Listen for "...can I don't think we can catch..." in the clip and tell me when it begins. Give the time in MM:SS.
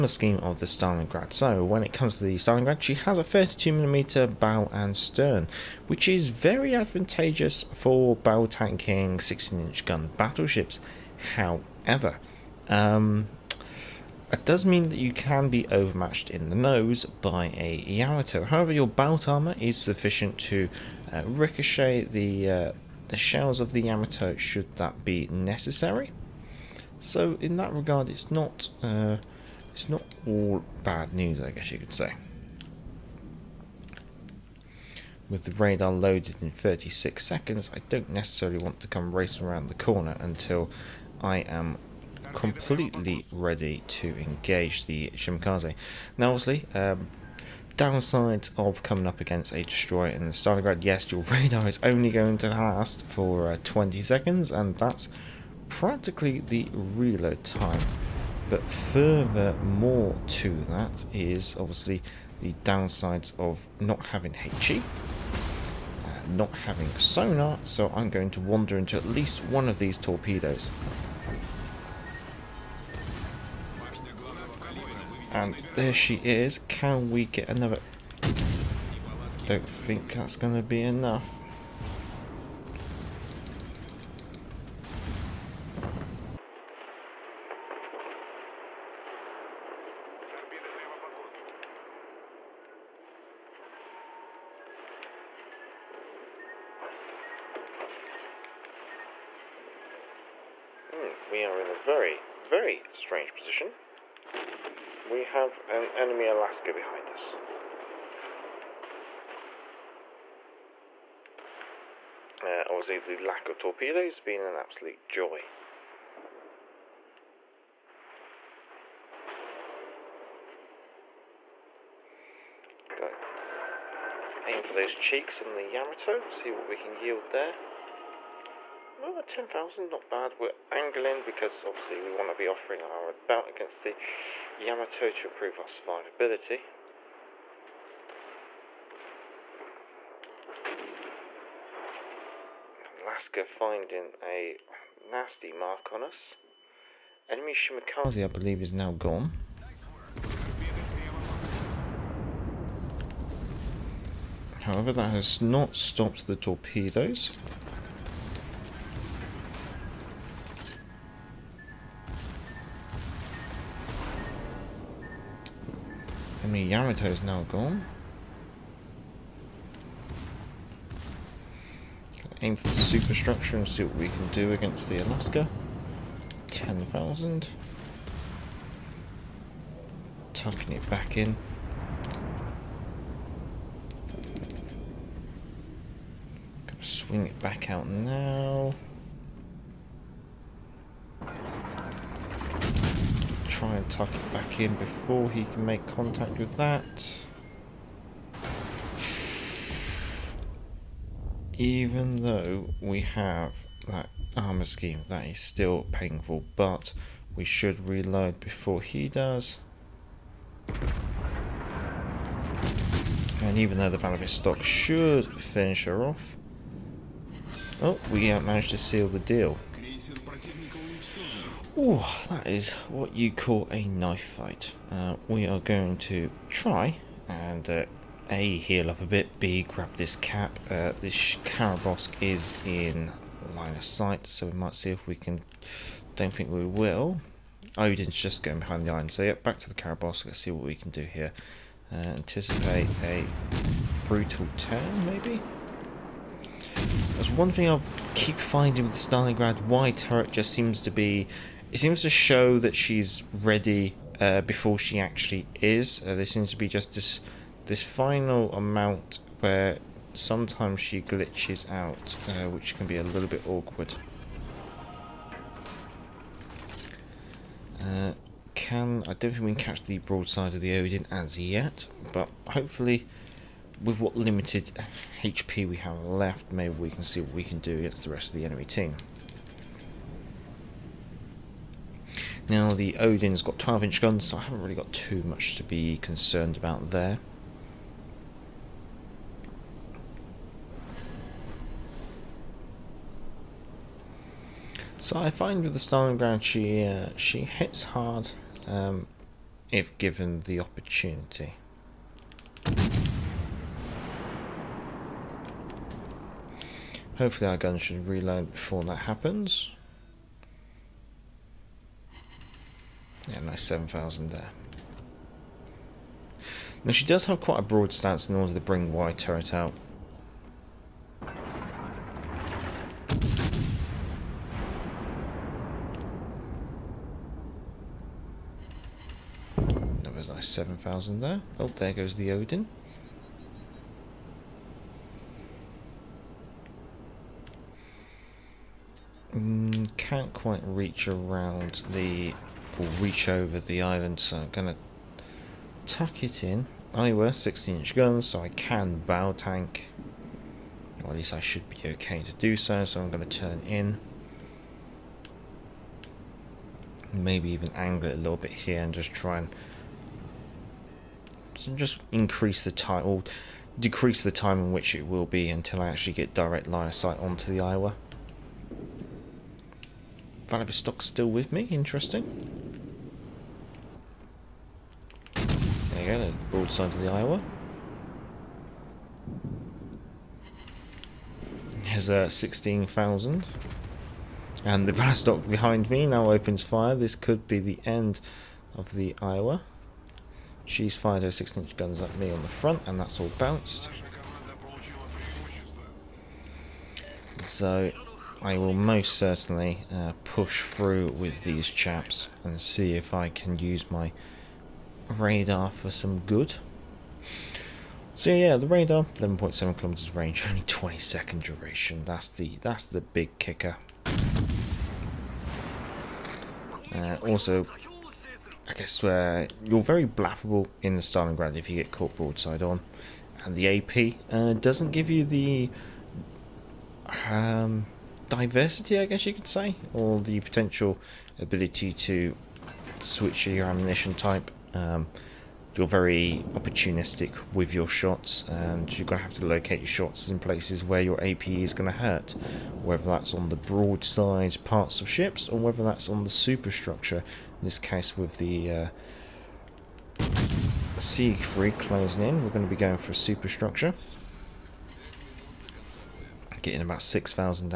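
04:28.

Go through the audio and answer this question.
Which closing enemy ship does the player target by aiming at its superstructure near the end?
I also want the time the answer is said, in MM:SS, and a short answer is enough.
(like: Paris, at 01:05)
Siegfried, at 07:30.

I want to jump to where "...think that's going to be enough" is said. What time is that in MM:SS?
01:19.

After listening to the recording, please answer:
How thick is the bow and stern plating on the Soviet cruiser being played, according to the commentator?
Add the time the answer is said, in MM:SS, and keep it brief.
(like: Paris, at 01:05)
32mm, at 00:03.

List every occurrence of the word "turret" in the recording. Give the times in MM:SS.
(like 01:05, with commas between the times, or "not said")
04:09, 05:19.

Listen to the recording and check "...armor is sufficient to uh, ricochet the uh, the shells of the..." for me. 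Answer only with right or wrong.
right.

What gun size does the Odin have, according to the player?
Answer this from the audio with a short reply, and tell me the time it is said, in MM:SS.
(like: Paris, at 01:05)
12 inch, at 04:43.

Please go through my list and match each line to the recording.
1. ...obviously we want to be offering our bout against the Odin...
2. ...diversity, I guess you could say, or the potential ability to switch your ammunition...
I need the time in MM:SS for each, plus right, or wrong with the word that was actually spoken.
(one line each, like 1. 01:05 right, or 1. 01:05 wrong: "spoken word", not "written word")
1. 02:11 wrong: "Yamato", not "Odin"
2. 07:08 right.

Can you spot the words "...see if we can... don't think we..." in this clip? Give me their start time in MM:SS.
03:54.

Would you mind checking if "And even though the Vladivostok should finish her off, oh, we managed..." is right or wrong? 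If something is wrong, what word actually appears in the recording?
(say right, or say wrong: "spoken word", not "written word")
right.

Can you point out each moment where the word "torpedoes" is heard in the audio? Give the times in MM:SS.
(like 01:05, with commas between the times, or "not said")
01:09, 01:53, 02:36.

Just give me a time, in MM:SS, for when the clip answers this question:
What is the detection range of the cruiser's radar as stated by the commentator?
06:49.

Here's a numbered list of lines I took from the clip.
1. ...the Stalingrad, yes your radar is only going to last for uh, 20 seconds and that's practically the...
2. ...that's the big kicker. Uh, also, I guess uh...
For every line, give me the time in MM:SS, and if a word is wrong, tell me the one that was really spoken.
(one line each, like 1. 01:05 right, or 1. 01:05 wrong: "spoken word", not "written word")
1. 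00:50 right
2. 06:52 right.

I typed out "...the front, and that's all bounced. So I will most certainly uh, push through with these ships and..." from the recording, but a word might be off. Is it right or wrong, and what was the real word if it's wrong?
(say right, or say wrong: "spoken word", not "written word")
wrong: "chaps", not "ships".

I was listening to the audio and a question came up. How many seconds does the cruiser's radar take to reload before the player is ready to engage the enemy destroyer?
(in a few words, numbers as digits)
36 seconds.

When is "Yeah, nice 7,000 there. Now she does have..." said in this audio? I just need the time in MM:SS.
05:13.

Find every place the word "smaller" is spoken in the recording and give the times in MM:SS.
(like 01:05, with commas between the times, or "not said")
not said.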